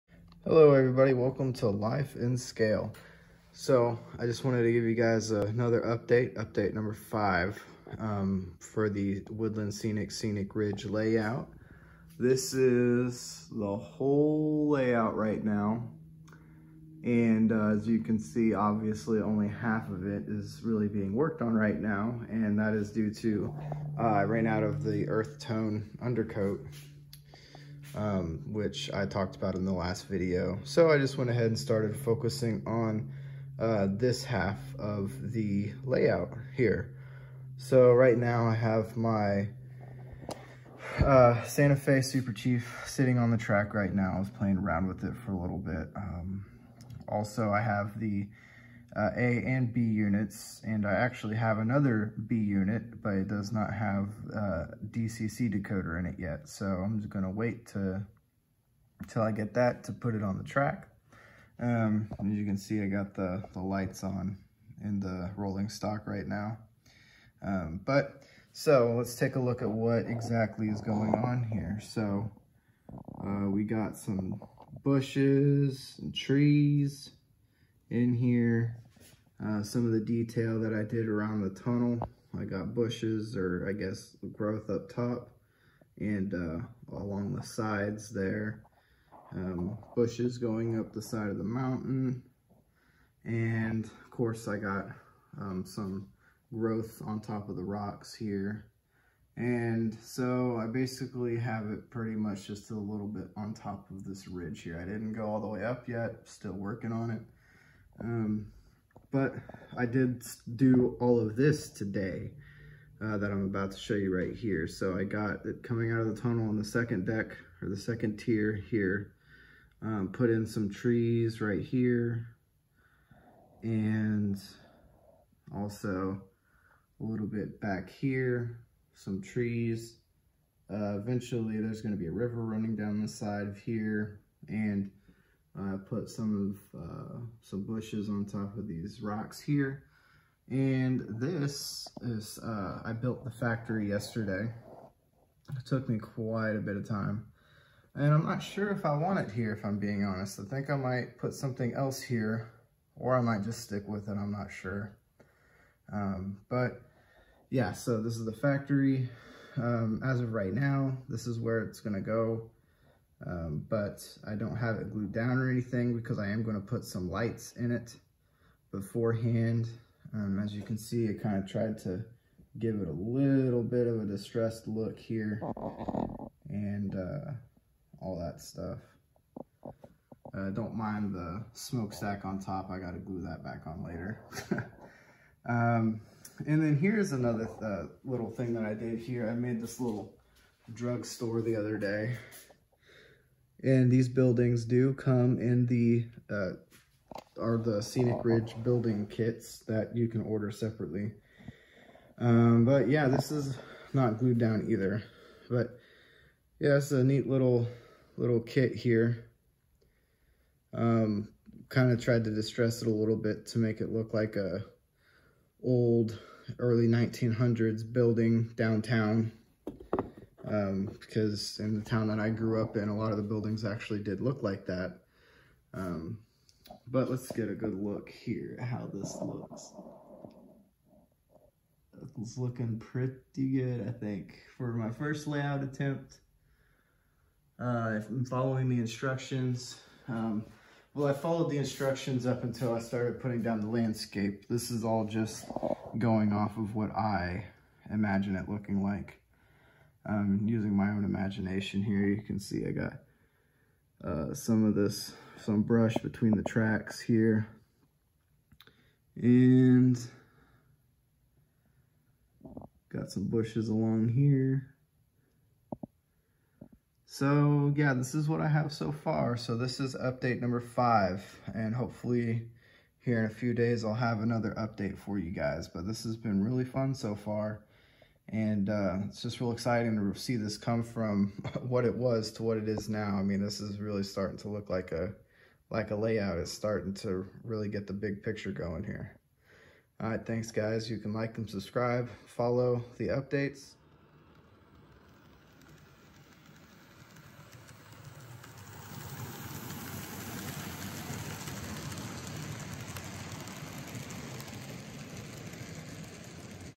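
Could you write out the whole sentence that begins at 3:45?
Um, but let's get a good look here at how this looks.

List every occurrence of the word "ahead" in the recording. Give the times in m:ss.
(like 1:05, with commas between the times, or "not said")
0:31.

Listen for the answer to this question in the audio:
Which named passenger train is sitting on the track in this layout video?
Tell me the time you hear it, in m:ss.
0:41.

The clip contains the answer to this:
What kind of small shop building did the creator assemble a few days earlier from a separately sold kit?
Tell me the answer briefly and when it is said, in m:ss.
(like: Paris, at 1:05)
drugstore, at 3:10.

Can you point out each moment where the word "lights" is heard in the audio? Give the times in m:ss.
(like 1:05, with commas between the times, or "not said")
1:03, 2:47.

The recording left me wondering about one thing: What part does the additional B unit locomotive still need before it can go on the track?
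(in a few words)
DCC decoder.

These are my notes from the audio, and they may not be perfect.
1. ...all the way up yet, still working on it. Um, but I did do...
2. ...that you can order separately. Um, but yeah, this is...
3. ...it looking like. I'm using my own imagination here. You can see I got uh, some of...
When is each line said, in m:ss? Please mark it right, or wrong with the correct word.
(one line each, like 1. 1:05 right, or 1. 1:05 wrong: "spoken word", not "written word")
1. 1:45 right
2. 3:19 right
3. 4:08 right.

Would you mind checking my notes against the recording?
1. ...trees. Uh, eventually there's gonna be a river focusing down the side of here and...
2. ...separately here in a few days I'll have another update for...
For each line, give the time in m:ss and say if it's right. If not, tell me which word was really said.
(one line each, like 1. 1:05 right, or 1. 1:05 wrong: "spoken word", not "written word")
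1. 2:09 wrong: "running", not "focusing"
2. 4:31 wrong: "hopefully", not "separately".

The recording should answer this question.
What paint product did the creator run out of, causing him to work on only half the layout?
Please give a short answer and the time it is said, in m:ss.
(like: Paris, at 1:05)
earth tone undercoat, at 0:25.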